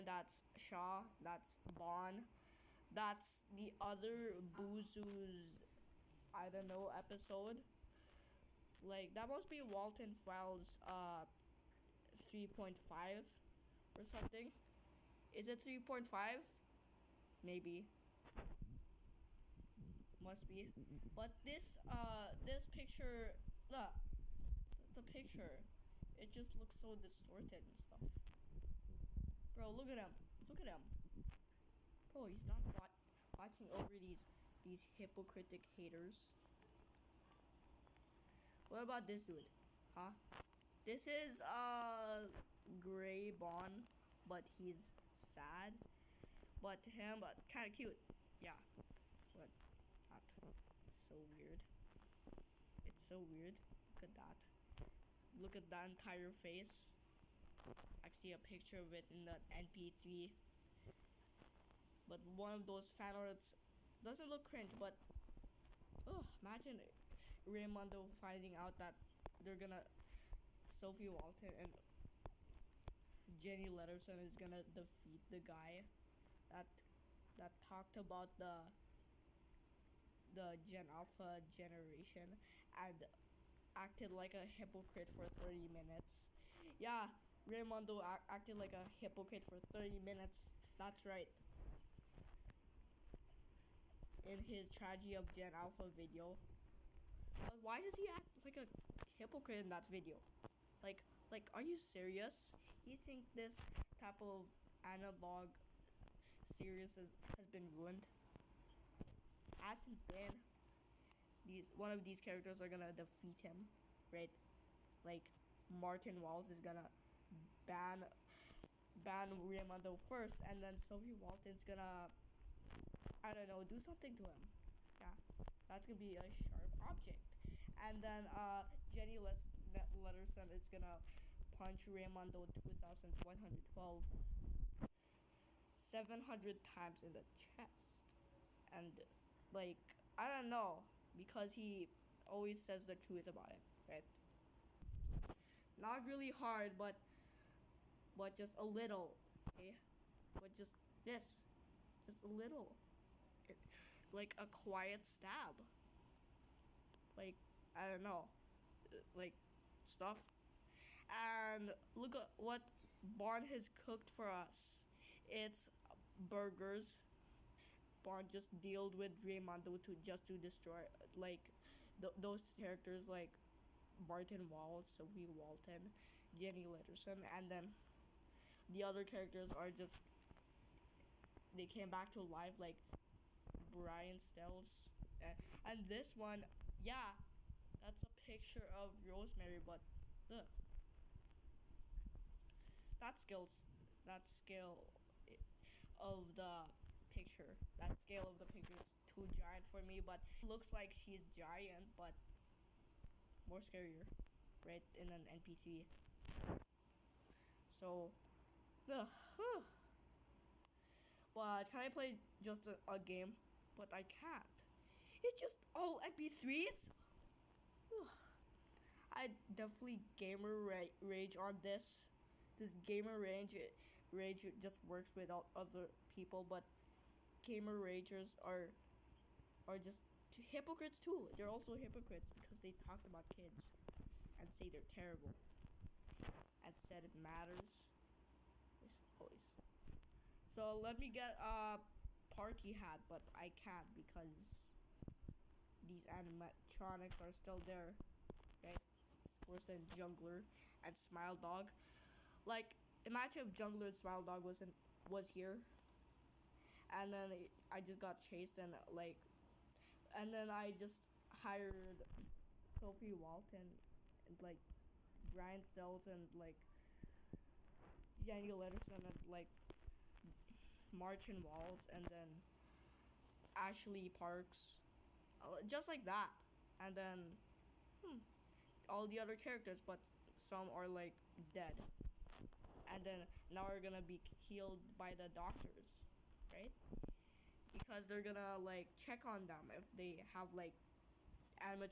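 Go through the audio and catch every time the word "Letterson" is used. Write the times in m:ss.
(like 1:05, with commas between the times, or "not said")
1:13, 2:09, 2:56, 4:28.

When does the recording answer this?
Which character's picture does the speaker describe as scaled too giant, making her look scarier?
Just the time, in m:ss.
3:09.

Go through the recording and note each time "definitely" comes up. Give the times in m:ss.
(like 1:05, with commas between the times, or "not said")
3:39.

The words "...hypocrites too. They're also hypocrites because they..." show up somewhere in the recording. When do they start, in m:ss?
3:50.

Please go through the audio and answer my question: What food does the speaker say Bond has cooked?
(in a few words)
Burgers.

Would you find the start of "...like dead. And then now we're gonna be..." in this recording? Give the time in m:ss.
4:40.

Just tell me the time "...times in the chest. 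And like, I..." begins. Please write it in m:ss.
2:16.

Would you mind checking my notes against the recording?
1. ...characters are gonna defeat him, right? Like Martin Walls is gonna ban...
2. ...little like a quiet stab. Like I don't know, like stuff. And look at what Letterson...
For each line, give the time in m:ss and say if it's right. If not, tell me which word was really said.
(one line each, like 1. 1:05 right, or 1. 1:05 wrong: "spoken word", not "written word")
1. 1:52 right
2. 2:32 wrong: "Bond", not "Letterson".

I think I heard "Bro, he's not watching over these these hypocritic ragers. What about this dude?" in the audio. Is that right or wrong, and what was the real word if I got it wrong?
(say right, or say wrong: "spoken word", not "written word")
wrong: "haters", not "ragers".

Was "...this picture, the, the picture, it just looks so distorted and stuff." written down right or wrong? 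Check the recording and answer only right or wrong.
right.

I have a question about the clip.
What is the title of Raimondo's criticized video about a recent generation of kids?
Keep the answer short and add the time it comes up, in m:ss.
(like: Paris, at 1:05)
Tragedy of Gen Alpha, at 1:34.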